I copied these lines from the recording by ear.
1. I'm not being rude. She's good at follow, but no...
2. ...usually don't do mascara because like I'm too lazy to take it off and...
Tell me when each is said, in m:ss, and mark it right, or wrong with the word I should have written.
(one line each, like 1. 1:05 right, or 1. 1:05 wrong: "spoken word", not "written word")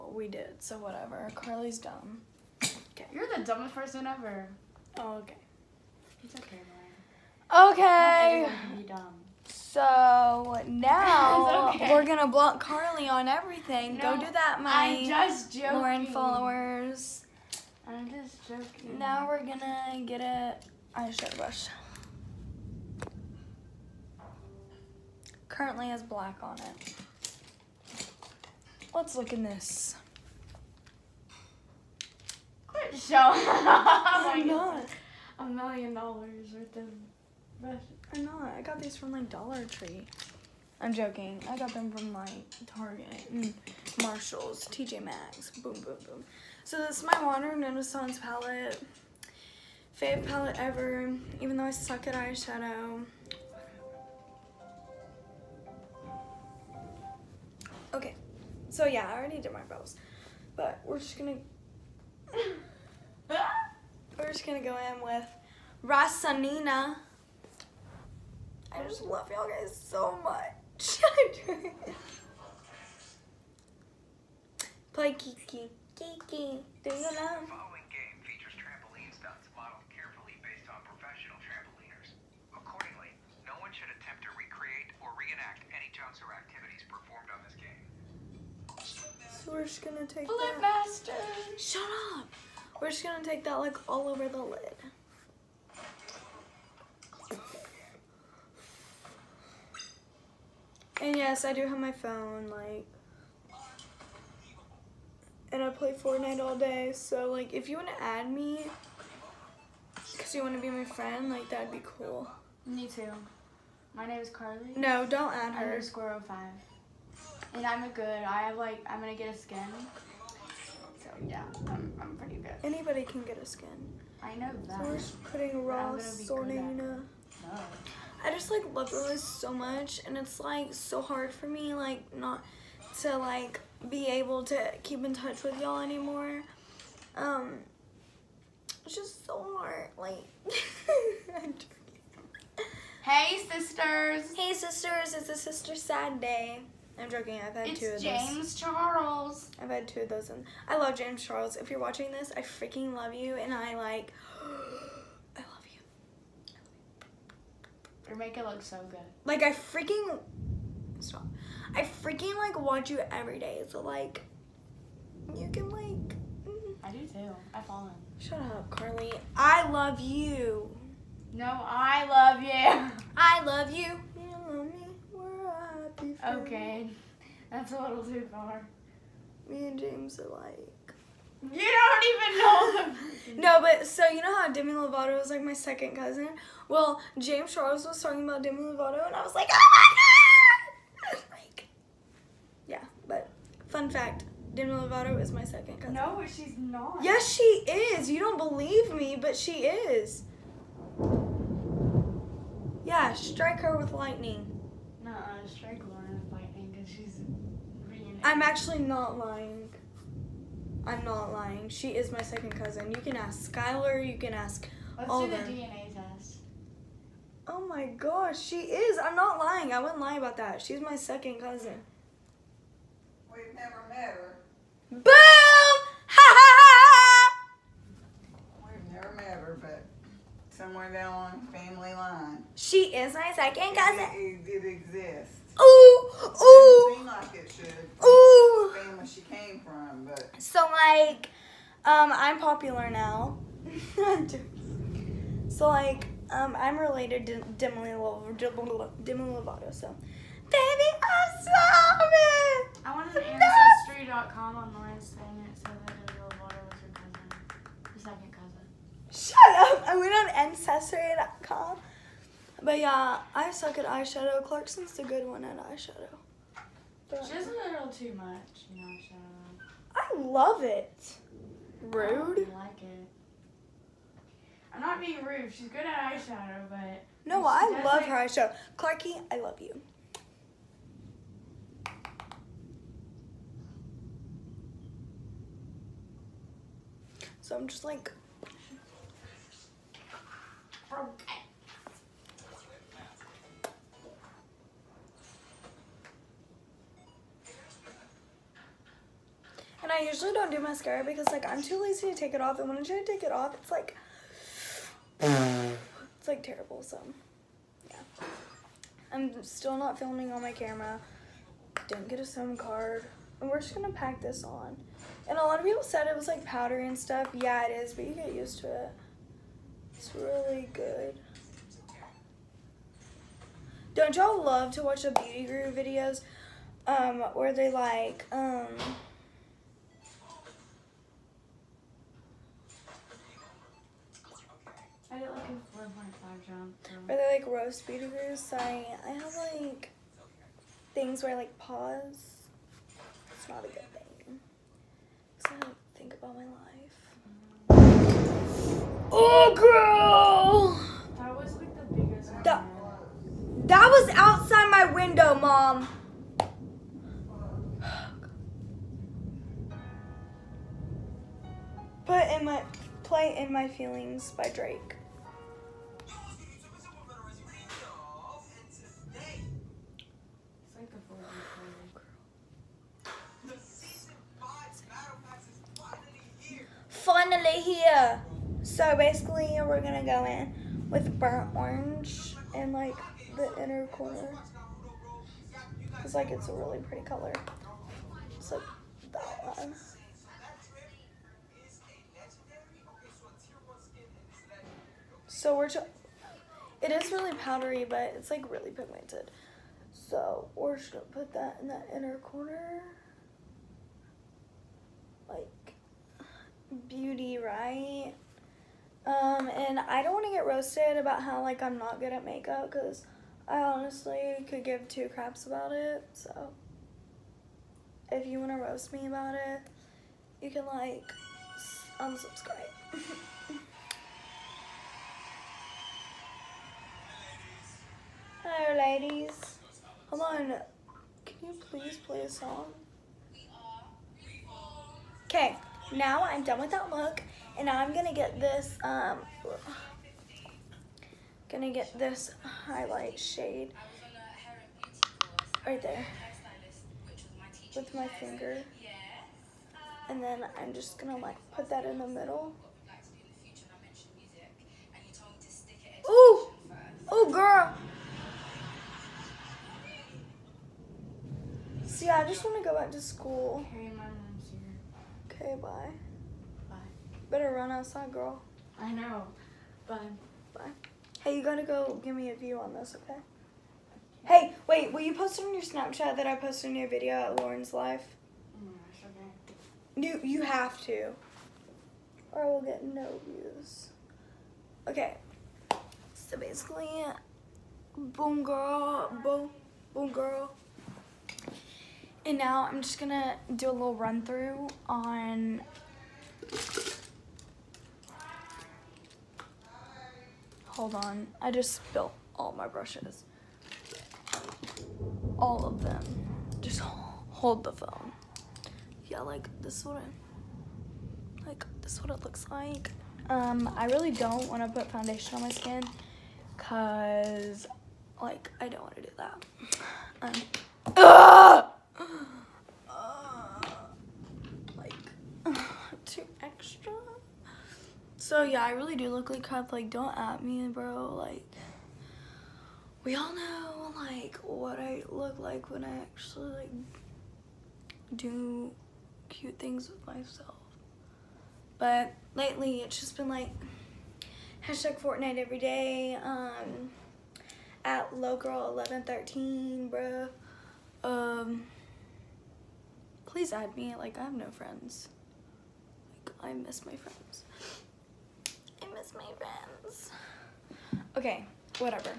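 1. 4:34 wrong: "eyeshadow", not "follow"
2. 5:00 right.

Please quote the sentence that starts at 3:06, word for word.
Well, James Charles was talking about Demi Lovato, and I was like, oh my god!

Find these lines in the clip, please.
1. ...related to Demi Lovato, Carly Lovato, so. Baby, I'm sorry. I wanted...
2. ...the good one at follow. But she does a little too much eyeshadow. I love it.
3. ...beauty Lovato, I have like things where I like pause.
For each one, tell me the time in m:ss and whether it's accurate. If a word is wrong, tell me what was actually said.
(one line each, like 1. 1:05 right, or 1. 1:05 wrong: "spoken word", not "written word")
1. 4:06 wrong: "Demi", not "Carly"
2. 4:24 wrong: "eyeshadow", not "follow"
3. 5:37 wrong: "Sorry", not "Lovato".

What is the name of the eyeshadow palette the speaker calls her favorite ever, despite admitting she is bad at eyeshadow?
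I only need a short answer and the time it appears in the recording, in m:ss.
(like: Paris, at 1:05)
Modern Renaissance, at 0:47.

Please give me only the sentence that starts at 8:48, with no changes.
So yeah, I really do look like cup.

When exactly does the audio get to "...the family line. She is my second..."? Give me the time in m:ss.
3:51.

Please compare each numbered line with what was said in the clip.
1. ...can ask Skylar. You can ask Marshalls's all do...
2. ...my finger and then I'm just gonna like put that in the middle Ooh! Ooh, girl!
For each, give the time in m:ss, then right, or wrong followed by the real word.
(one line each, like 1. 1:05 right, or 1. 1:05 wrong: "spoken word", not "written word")
1. 3:33 wrong: "Let", not "Marshalls"
2. 7:27 right.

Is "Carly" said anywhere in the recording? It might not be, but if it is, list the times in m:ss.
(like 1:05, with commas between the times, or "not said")
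0:01, 0:12, 1:54, 2:48.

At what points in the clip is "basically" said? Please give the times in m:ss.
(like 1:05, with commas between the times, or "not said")
6:18, 8:06.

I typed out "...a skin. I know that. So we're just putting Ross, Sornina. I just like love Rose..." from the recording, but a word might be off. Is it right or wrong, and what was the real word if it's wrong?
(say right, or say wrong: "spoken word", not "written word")
right.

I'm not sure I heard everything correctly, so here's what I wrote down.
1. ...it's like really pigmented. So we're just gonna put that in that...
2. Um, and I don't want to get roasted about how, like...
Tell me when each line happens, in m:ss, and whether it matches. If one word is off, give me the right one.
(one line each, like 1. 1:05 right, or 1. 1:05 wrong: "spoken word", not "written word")
1. 6:38 right
2. 6:49 right.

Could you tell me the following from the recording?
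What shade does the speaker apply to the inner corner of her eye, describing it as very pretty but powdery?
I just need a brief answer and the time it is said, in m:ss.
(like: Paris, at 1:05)
Burnt orange, at 6:21.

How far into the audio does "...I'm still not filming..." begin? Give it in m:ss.
5:09.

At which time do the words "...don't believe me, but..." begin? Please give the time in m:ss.
3:18.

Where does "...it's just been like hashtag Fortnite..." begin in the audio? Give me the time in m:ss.
9:02.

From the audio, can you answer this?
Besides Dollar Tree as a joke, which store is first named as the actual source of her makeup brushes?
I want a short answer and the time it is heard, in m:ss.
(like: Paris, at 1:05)
Target, at 0:42.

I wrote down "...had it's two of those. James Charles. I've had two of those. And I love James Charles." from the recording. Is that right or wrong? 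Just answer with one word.
right.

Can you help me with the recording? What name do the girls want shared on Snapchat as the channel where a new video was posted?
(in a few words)
Lauren's Life.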